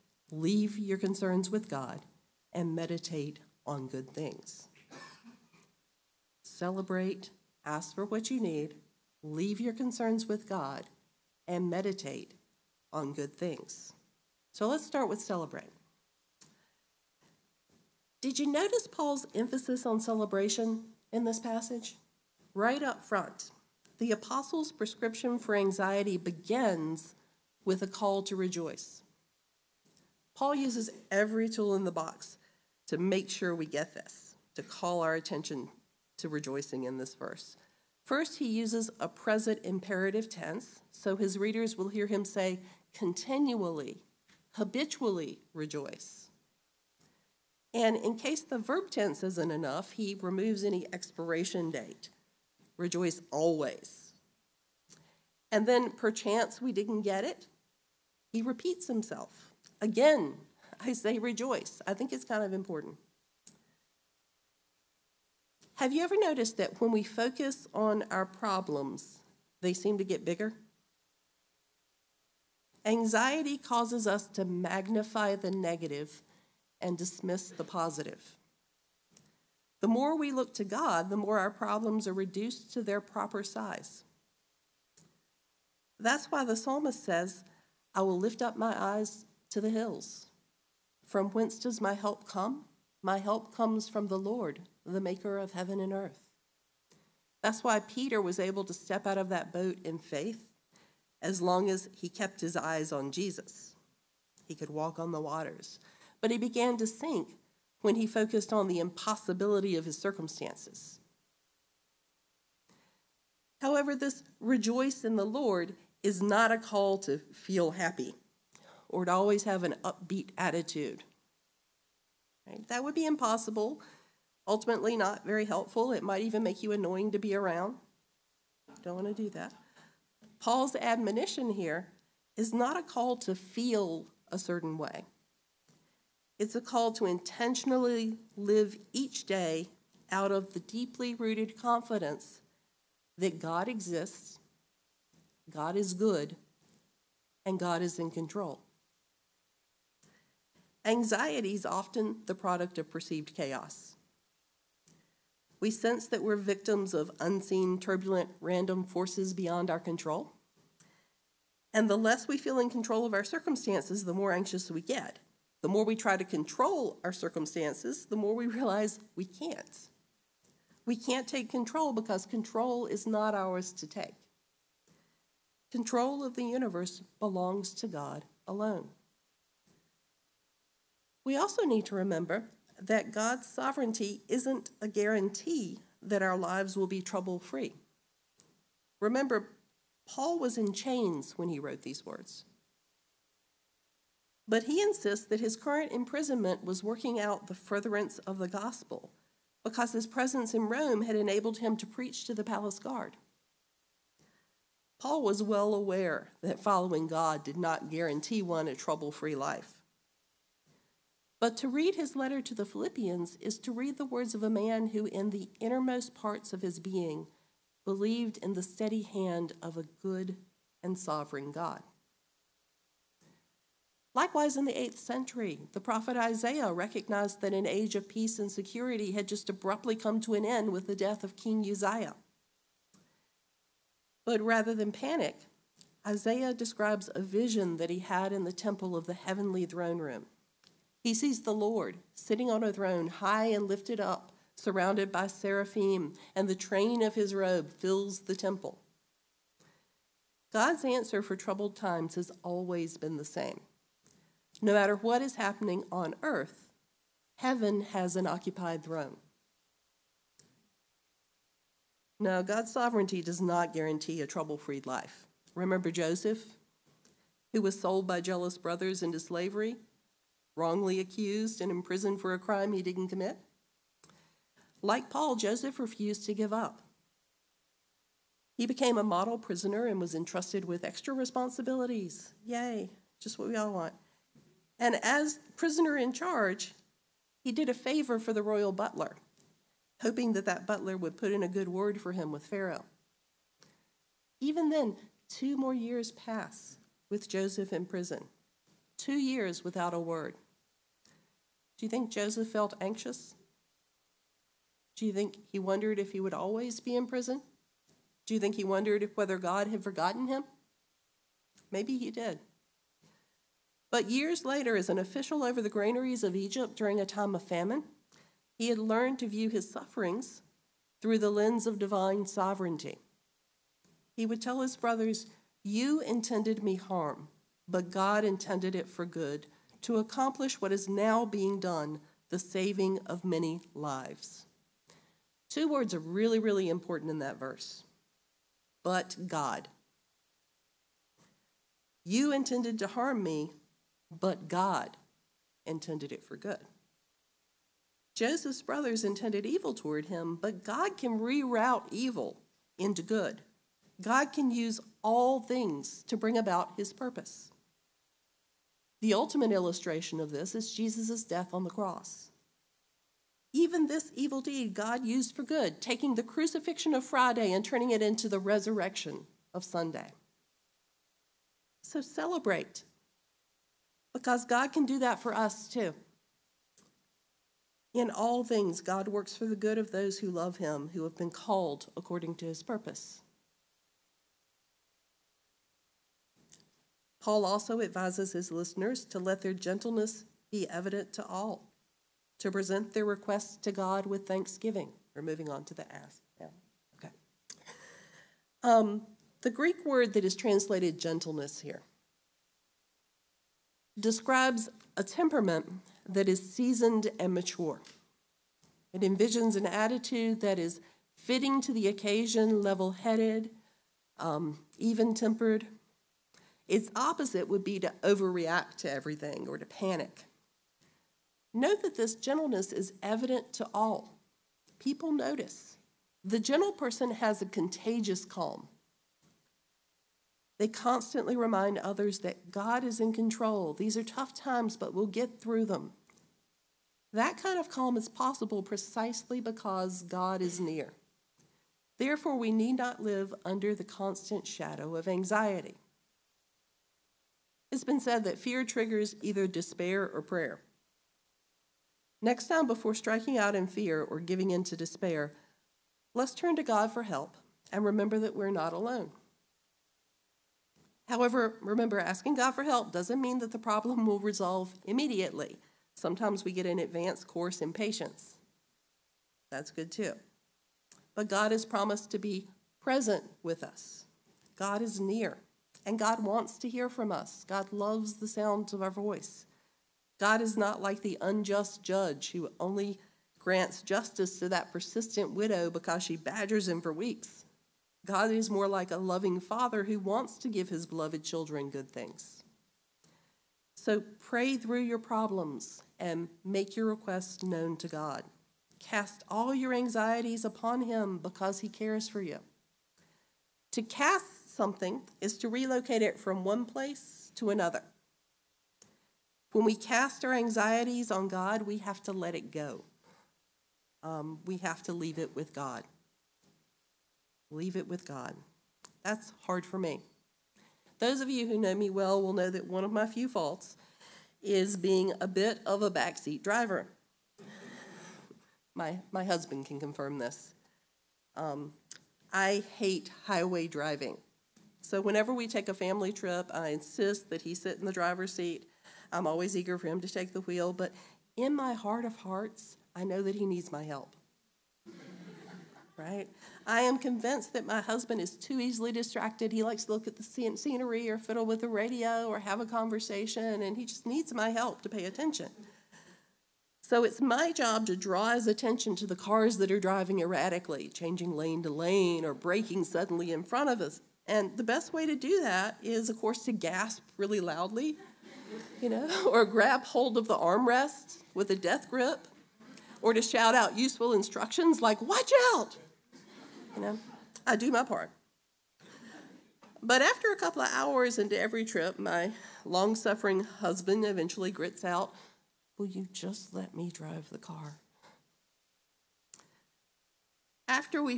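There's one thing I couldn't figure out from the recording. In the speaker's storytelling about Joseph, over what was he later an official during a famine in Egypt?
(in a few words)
the granaries.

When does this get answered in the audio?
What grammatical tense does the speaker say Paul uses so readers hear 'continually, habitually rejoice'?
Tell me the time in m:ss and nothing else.
0:39.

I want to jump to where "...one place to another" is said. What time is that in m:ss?
8:26.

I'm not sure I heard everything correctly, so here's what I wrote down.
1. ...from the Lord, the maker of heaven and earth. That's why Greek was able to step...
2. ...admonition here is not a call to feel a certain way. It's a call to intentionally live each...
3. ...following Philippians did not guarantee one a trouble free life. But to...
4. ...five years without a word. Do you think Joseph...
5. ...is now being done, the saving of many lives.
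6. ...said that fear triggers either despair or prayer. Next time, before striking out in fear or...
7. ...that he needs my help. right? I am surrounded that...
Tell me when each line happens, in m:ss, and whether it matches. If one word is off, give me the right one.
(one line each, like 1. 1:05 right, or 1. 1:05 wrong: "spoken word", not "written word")
1. 1:33 wrong: "Peter", not "Greek"
2. 2:10 right
3. 3:26 wrong: "God", not "Philippians"
4. 4:58 wrong: "two", not "five"
5. 5:30 right
6. 7:28 right
7. 9:03 wrong: "convinced", not "surrounded".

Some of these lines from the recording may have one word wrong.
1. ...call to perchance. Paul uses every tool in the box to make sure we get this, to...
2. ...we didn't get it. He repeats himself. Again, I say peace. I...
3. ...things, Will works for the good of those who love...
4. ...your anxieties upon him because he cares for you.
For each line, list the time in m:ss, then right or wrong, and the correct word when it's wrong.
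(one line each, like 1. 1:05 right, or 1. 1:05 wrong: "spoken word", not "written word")
1. 0:27 wrong: "rejoice", not "perchance"
2. 0:56 wrong: "rejoice", not "peace"
3. 6:18 wrong: "God", not "Will"
4. 8:19 right.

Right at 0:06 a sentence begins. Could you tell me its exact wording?
Celebrate, ask for what you need, leave your concerns with God, and meditate on good things.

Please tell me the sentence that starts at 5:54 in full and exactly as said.
God can use all things to bring about his purpose.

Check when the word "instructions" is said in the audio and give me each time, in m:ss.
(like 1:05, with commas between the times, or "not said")
9:34.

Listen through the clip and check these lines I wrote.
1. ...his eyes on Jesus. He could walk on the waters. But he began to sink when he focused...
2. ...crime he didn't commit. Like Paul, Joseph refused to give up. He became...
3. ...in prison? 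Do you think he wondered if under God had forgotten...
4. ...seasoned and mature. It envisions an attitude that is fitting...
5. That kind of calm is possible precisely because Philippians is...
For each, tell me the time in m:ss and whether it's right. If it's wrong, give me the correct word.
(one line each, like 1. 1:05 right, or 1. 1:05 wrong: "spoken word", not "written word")
1. 1:42 right
2. 4:32 right
3. 5:06 wrong: "whether", not "under"
4. 6:46 right
5. 7:17 wrong: "God", not "Philippians".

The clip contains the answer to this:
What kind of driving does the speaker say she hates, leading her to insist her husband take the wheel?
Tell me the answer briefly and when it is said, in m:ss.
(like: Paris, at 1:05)
highway driving, at 8:53.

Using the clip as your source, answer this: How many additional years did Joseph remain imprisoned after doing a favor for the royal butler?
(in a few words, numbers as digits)
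2.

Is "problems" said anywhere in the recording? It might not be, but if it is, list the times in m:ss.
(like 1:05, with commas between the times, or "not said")
1:08, 1:21, 7:43, 8:14.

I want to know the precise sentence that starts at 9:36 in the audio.
You know, I do my part.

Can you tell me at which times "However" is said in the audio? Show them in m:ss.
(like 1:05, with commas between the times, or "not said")
1:53, 7:41.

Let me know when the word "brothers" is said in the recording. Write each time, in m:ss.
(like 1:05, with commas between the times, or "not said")
4:28, 5:24, 5:48.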